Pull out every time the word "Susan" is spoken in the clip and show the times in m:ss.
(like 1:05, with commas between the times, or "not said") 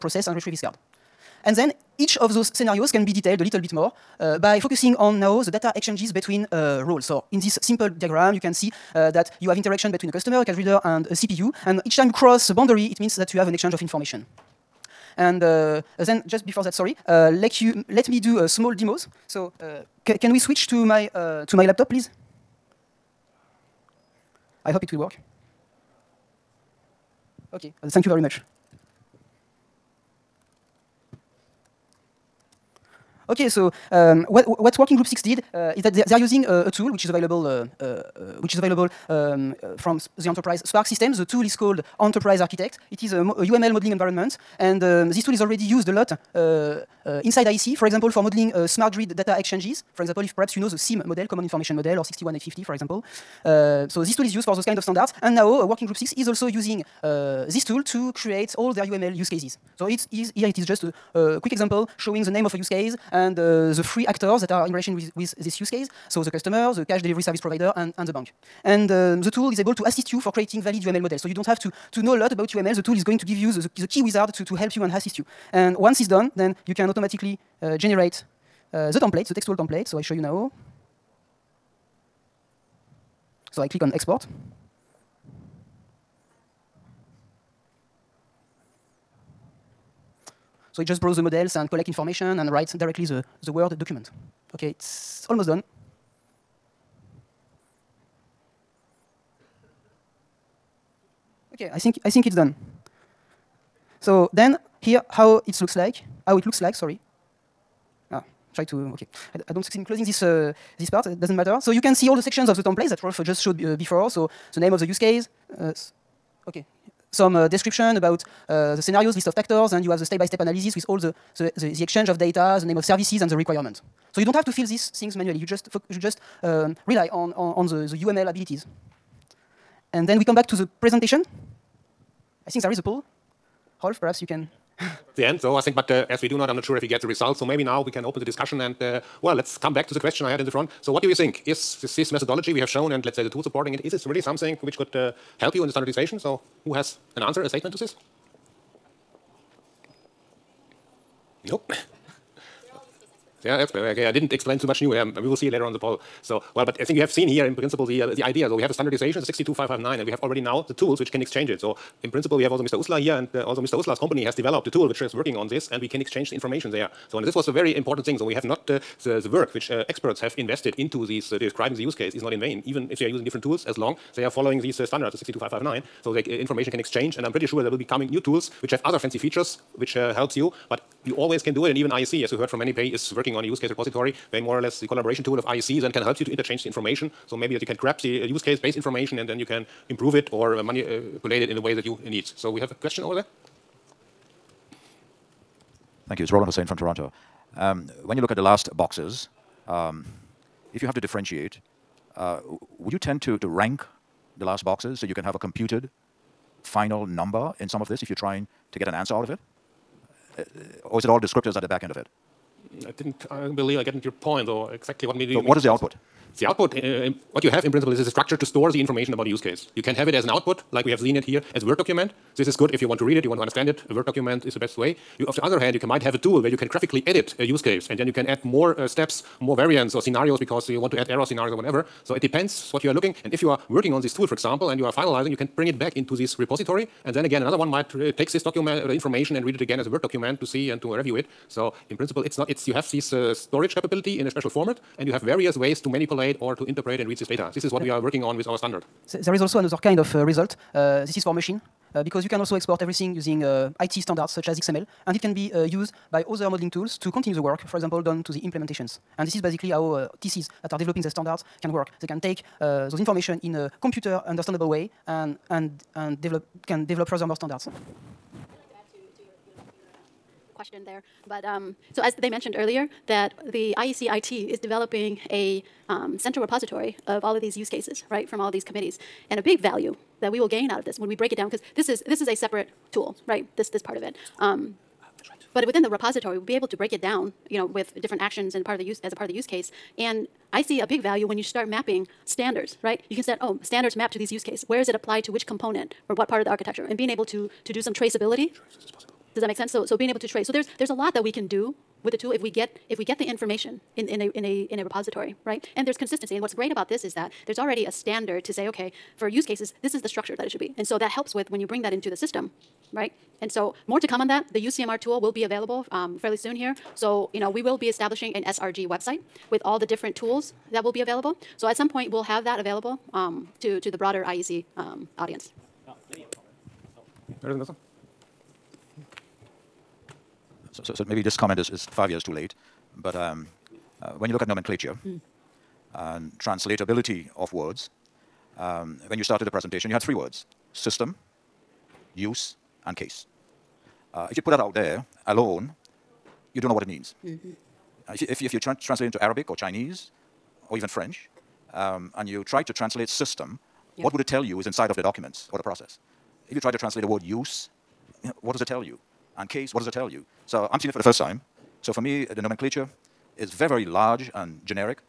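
not said.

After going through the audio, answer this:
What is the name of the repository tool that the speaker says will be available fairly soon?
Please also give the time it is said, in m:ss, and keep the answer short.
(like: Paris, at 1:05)
UCMR, at 5:14.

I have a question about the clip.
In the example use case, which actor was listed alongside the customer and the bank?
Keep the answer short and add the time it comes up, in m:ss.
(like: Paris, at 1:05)
cash delivery service provider, at 1:06.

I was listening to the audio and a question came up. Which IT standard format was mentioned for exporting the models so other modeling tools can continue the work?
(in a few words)
XML.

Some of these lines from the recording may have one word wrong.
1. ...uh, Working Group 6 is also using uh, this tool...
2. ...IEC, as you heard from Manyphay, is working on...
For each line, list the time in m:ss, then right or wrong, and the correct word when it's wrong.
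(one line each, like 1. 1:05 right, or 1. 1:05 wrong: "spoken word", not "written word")
1. 0:55 right
2. 3:01 right.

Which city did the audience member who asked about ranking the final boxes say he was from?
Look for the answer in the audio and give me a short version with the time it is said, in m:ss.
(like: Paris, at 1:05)
Toronto, at 3:16.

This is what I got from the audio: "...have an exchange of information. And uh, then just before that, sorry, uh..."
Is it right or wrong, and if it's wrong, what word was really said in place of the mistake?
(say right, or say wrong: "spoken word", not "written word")
right.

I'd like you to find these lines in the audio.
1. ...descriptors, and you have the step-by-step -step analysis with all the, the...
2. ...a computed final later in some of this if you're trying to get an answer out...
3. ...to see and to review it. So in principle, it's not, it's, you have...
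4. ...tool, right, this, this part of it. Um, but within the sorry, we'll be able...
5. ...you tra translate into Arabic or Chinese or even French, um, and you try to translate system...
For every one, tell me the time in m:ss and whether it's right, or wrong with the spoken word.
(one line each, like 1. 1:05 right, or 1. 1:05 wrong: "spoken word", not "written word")
1. 1:59 wrong: "actors", not "descriptors"
2. 3:25 wrong: "number", not "later"
3. 4:00 right
4. 4:42 wrong: "repository", not "sorry"
5. 5:48 right.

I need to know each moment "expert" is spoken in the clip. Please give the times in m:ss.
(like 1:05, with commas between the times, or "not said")
2:33, 2:49.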